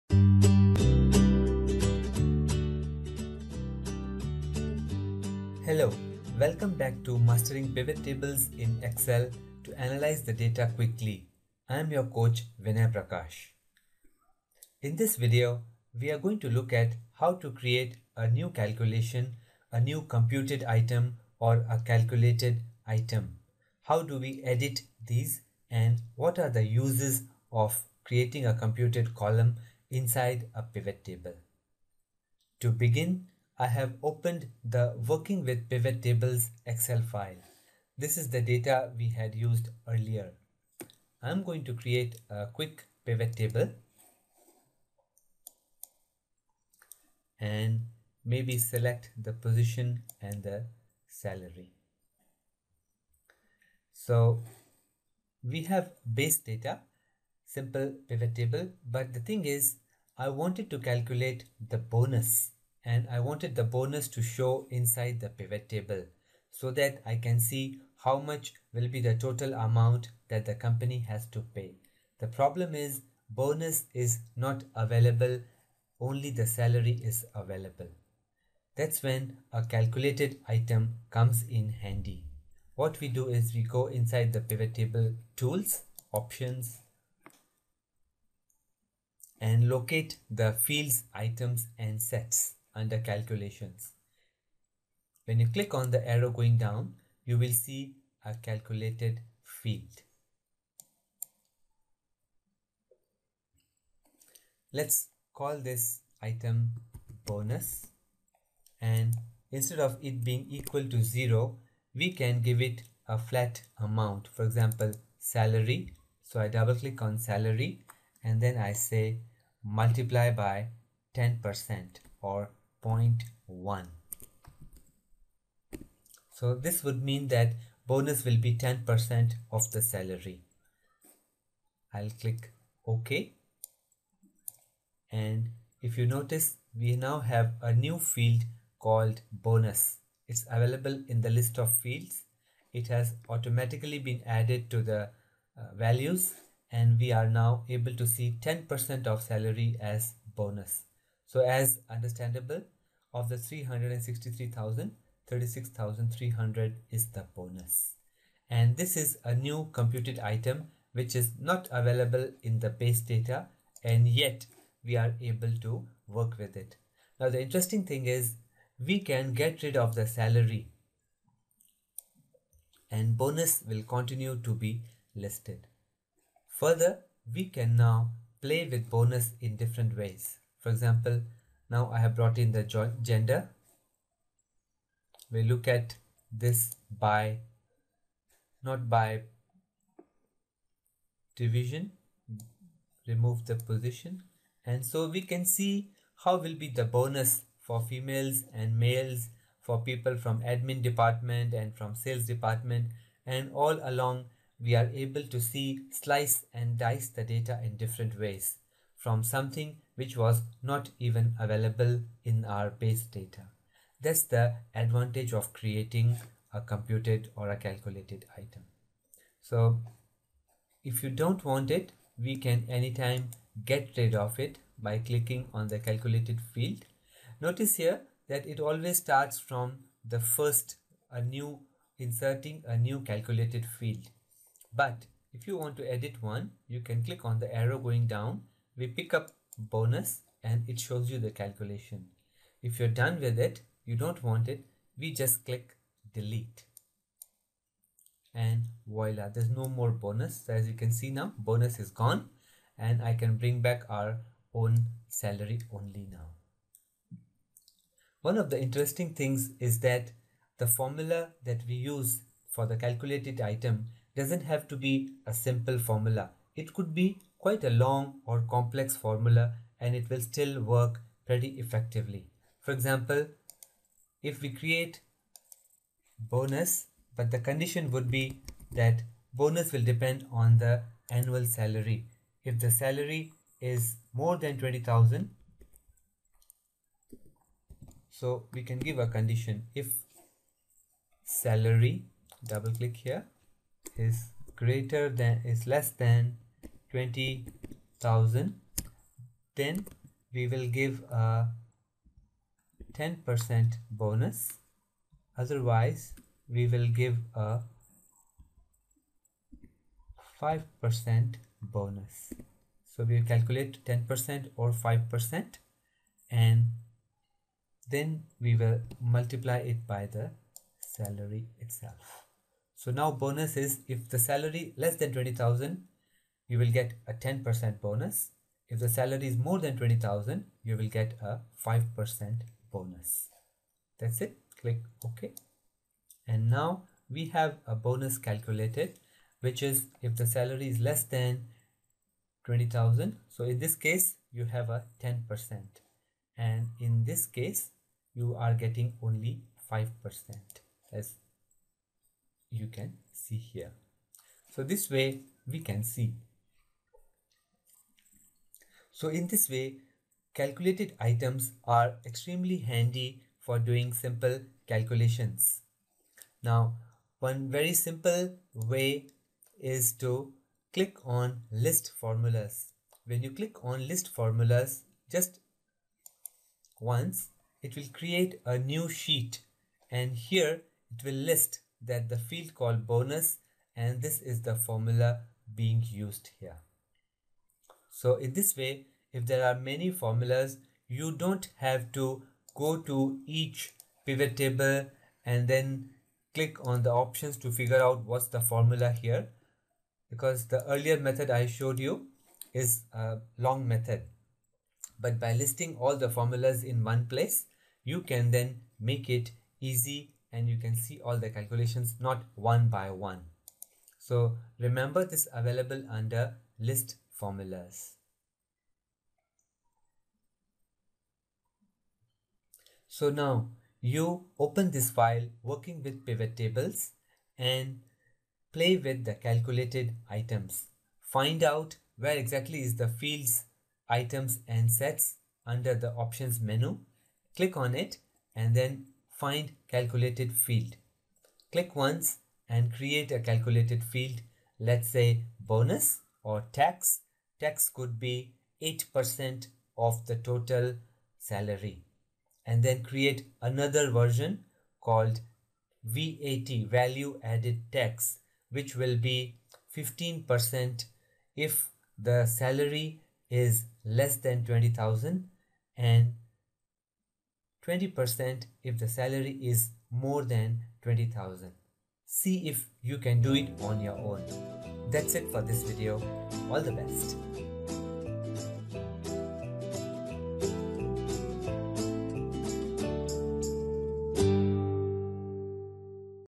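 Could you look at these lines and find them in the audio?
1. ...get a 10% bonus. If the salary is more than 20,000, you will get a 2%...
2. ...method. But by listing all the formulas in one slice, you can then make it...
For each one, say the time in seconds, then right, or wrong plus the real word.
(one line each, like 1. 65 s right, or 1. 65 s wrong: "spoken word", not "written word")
1. 326 s wrong: "5", not "2"
2. 403 s wrong: "place", not "slice".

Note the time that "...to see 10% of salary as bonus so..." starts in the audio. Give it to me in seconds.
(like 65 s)
147 s.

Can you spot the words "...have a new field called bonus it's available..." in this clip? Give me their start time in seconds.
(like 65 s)
137 s.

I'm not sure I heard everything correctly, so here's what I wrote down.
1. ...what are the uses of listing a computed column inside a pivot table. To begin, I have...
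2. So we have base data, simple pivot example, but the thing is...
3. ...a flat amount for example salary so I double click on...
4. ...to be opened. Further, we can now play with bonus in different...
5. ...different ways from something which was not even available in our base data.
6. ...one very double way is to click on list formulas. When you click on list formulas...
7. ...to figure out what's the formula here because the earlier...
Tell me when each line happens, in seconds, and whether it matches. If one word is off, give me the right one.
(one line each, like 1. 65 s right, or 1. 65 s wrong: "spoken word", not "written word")
1. 26 s wrong: "creating", not "listing"
2. 53 s wrong: "table", not "example"
3. 113 s right
4. 174 s wrong: "listed", not "opened"
5. 207 s right
6. 367 s wrong: "simple", not "double"
7. 397 s right.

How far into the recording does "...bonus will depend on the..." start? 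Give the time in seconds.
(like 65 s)
279 s.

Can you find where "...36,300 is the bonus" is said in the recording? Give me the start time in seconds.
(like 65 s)
155 s.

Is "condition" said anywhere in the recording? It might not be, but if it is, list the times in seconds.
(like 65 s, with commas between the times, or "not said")
277 s, 289 s.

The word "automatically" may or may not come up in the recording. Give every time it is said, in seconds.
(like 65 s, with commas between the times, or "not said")
143 s.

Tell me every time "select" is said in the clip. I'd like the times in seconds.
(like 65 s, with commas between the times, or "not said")
48 s.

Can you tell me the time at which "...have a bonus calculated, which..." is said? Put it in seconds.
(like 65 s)
337 s.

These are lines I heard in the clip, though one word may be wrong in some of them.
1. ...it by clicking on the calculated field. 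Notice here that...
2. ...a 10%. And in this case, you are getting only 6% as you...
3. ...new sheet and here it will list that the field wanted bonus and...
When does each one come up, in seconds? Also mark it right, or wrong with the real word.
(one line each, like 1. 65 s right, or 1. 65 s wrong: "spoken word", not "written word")
1. 224 s right
2. 344 s wrong: "5", not "6"
3. 378 s wrong: "called", not "wanted".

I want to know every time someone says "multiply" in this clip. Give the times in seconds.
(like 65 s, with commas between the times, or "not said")
119 s, 319 s.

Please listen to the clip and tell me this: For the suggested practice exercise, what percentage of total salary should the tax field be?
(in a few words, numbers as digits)
8%.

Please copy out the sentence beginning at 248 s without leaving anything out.
And voila, there's no more bonus.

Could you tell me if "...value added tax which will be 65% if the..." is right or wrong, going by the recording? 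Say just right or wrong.
wrong.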